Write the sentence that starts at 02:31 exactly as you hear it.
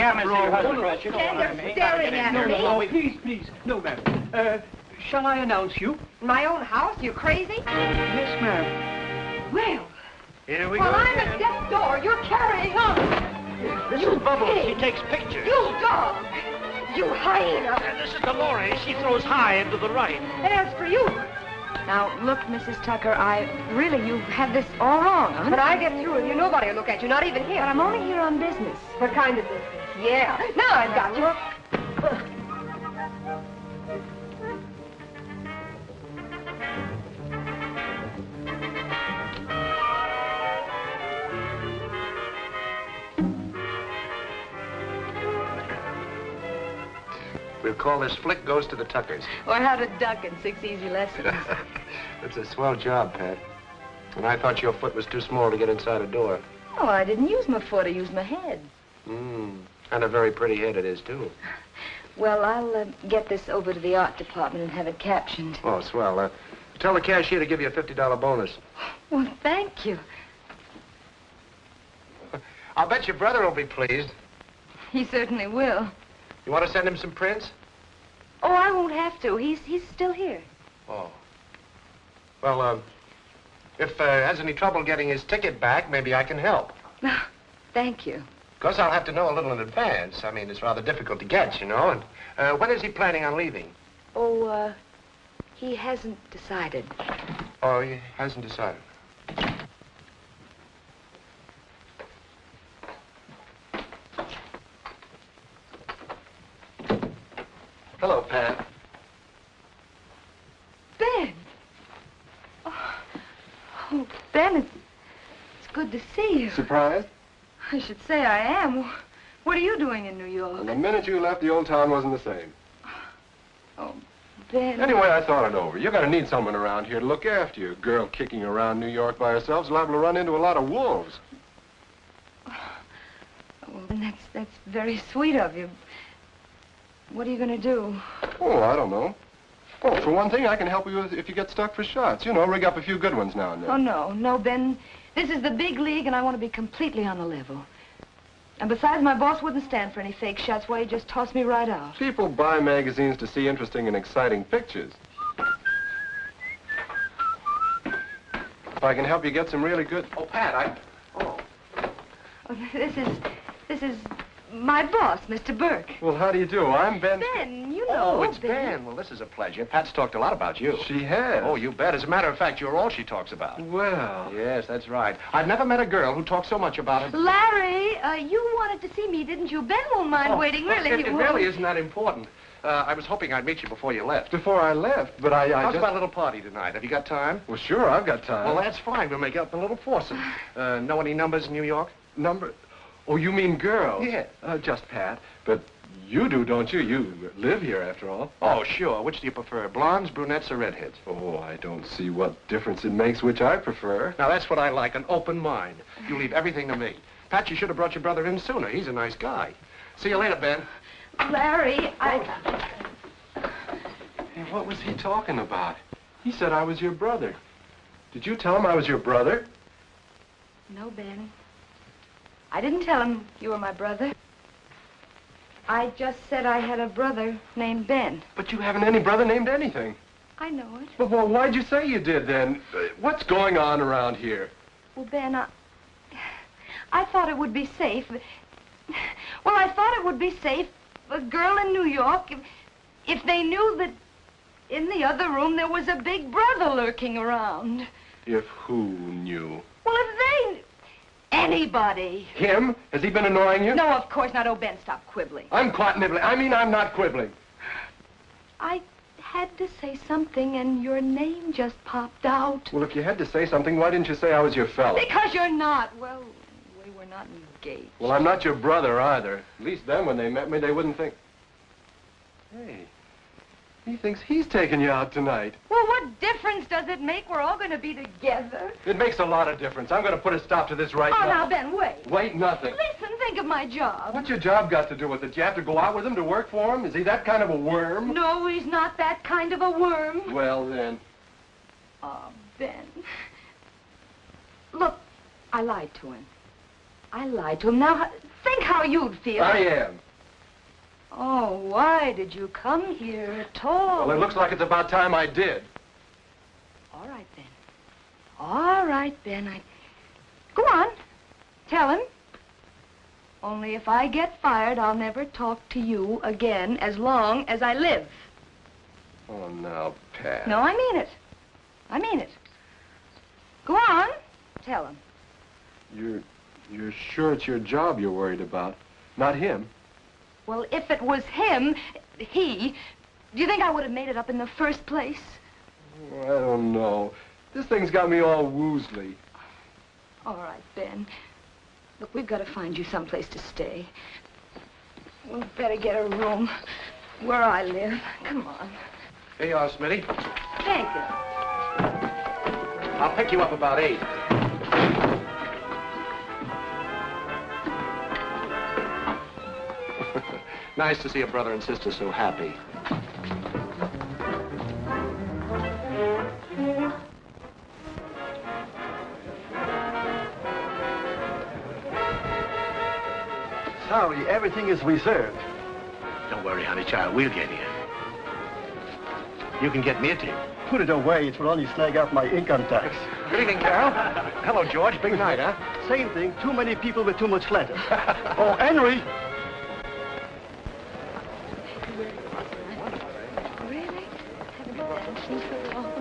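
People buy magazines to see interesting and exciting pictures.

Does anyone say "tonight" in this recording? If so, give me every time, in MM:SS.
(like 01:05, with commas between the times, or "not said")
03:06, 04:35.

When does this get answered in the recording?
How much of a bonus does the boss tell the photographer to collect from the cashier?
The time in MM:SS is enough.
01:07.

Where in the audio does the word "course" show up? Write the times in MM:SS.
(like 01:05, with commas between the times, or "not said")
01:28, 04:14.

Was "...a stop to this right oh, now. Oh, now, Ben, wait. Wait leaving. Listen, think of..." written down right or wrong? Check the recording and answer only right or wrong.
wrong.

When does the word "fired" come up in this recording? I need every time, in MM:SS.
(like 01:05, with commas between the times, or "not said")
05:14.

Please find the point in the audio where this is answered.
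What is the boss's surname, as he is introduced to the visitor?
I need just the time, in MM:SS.
02:45.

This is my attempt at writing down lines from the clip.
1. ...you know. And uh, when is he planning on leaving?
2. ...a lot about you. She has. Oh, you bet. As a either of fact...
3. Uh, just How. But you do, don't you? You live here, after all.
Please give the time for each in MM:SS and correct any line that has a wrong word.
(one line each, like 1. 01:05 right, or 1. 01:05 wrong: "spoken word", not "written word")
1. 01:31 right
2. 02:50 wrong: "matter", not "either"
3. 03:14 wrong: "Pat", not "How".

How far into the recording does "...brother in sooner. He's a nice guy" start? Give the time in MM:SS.
03:28.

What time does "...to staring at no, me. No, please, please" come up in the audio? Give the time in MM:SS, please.
00:01.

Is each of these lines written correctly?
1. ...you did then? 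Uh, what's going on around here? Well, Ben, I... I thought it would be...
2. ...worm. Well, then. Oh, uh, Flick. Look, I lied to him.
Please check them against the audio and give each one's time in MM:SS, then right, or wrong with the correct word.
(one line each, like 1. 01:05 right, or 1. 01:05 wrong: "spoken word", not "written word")
1. 03:51 right
2. 04:49 wrong: "Ben", not "Flick".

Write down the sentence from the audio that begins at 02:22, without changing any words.
You know, rig up a few good ones now and then.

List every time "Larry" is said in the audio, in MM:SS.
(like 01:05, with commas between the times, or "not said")
02:57, 03:31.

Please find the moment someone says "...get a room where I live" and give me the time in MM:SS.
05:45.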